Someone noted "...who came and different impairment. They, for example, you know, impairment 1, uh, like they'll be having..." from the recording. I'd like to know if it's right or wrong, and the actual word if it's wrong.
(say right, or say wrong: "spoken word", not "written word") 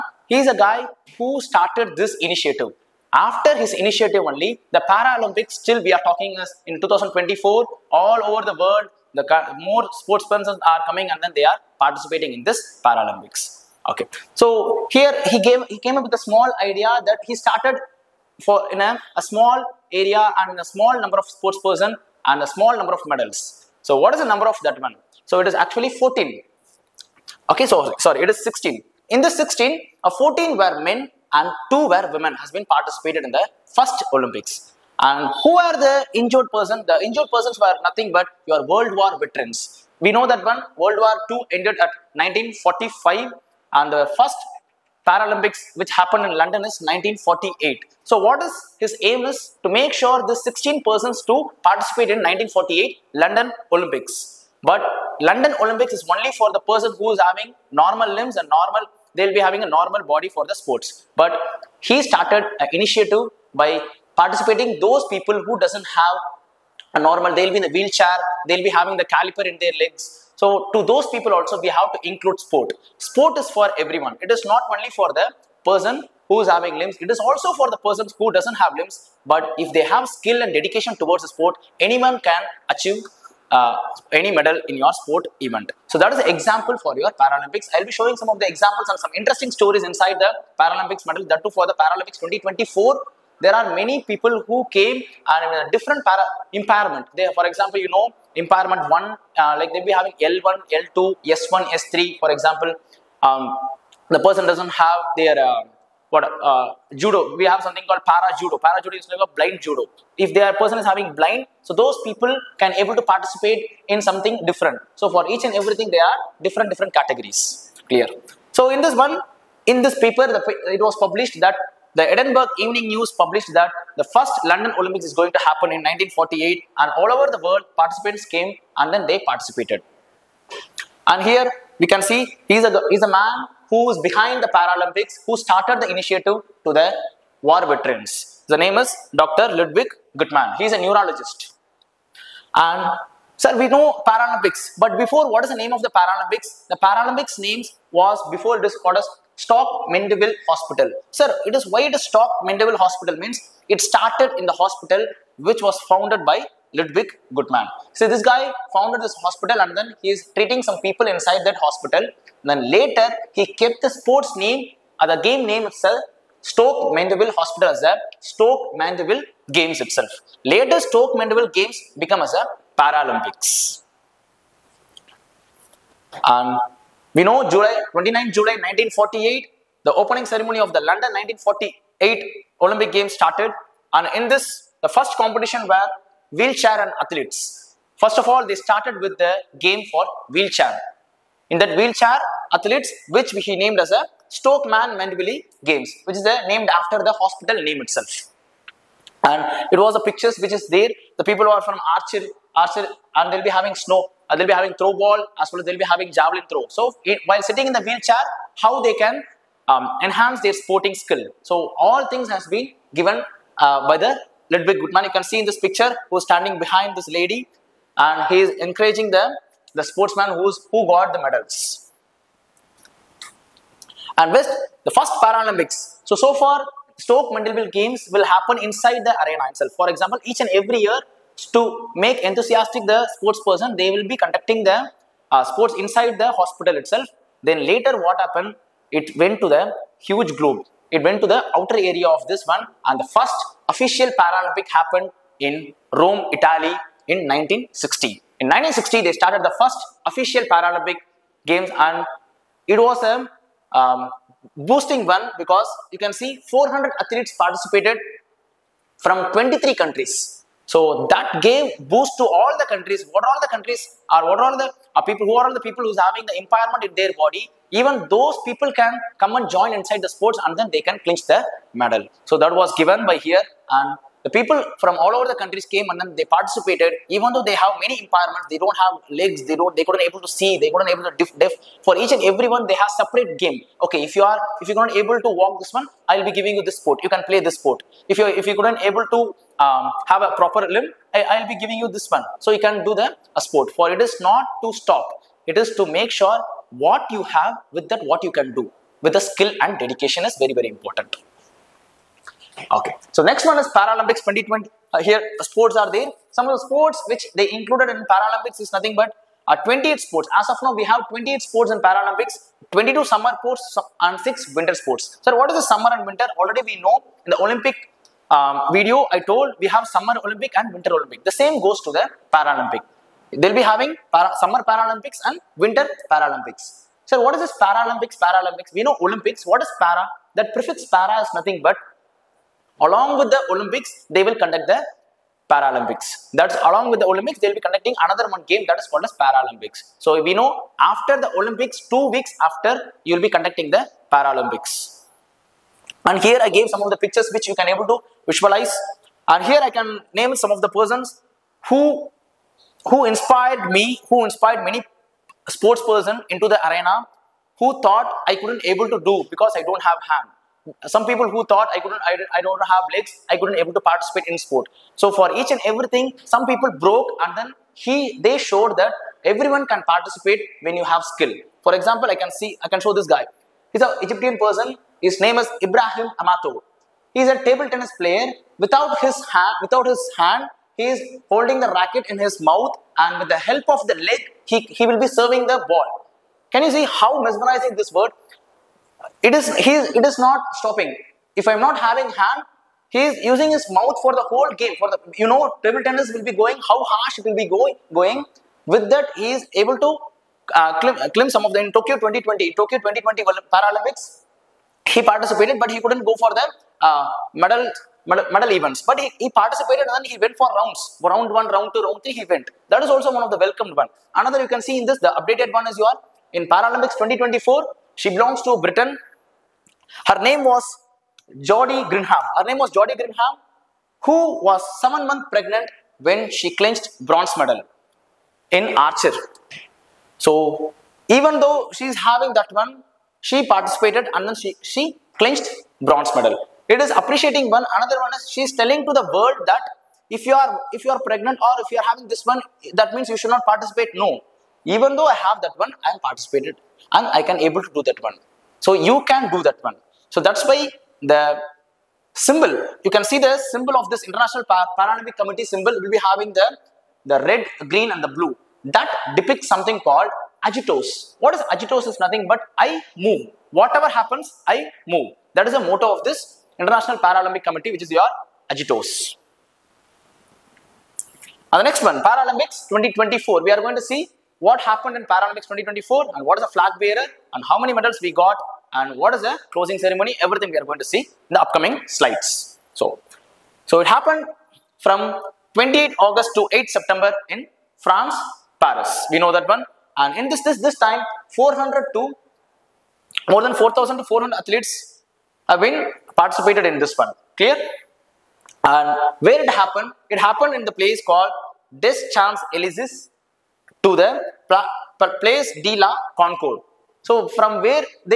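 right.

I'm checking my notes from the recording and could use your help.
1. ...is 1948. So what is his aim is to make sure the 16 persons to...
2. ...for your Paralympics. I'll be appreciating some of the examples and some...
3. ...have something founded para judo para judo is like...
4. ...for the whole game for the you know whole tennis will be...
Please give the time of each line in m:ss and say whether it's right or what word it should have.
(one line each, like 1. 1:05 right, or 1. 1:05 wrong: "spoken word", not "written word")
1. 0:46 right
2. 1:26 wrong: "showing", not "appreciating"
3. 1:47 wrong: "called", not "founded"
4. 6:34 wrong: "table", not "whole".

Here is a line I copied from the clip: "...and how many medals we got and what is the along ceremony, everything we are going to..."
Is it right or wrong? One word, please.
wrong.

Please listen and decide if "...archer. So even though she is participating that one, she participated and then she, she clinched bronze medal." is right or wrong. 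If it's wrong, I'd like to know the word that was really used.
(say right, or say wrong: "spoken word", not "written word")
wrong: "having", not "participating".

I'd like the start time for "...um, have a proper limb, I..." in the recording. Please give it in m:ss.
4:49.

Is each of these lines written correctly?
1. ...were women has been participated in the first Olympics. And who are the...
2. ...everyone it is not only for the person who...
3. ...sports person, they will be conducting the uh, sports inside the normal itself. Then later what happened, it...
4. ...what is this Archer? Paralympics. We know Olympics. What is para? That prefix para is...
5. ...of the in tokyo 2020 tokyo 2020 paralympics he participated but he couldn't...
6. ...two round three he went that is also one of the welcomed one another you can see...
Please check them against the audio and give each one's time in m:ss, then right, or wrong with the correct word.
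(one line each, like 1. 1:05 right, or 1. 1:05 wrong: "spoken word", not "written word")
1. 0:31 right
2. 1:13 right
3. 3:53 wrong: "hospital", not "normal"
4. 5:27 wrong: "Paralympics", not "Archer"
5. 6:41 right
6. 6:51 right.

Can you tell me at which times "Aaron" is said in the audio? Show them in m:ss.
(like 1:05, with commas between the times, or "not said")
not said.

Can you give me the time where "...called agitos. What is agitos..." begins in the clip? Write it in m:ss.
7:39.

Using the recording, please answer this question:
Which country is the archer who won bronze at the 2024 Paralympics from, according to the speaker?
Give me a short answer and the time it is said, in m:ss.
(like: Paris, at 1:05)
Britain, at 6:58.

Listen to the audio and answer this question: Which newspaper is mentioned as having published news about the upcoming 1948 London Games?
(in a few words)
Edinburgh Evening News.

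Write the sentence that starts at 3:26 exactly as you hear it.
So it, eh, while sitting in the wheelchair, how they can um, enhance their sporting skill.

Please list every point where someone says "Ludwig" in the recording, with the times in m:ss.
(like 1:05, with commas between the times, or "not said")
2:19, 2:36, 3:34.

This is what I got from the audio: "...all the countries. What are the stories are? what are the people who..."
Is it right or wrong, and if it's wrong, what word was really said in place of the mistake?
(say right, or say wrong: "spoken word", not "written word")
wrong: "countries", not "stories".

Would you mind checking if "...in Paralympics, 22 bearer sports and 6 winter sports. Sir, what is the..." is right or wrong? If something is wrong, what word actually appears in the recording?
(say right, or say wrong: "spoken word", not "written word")
wrong: "summer", not "bearer".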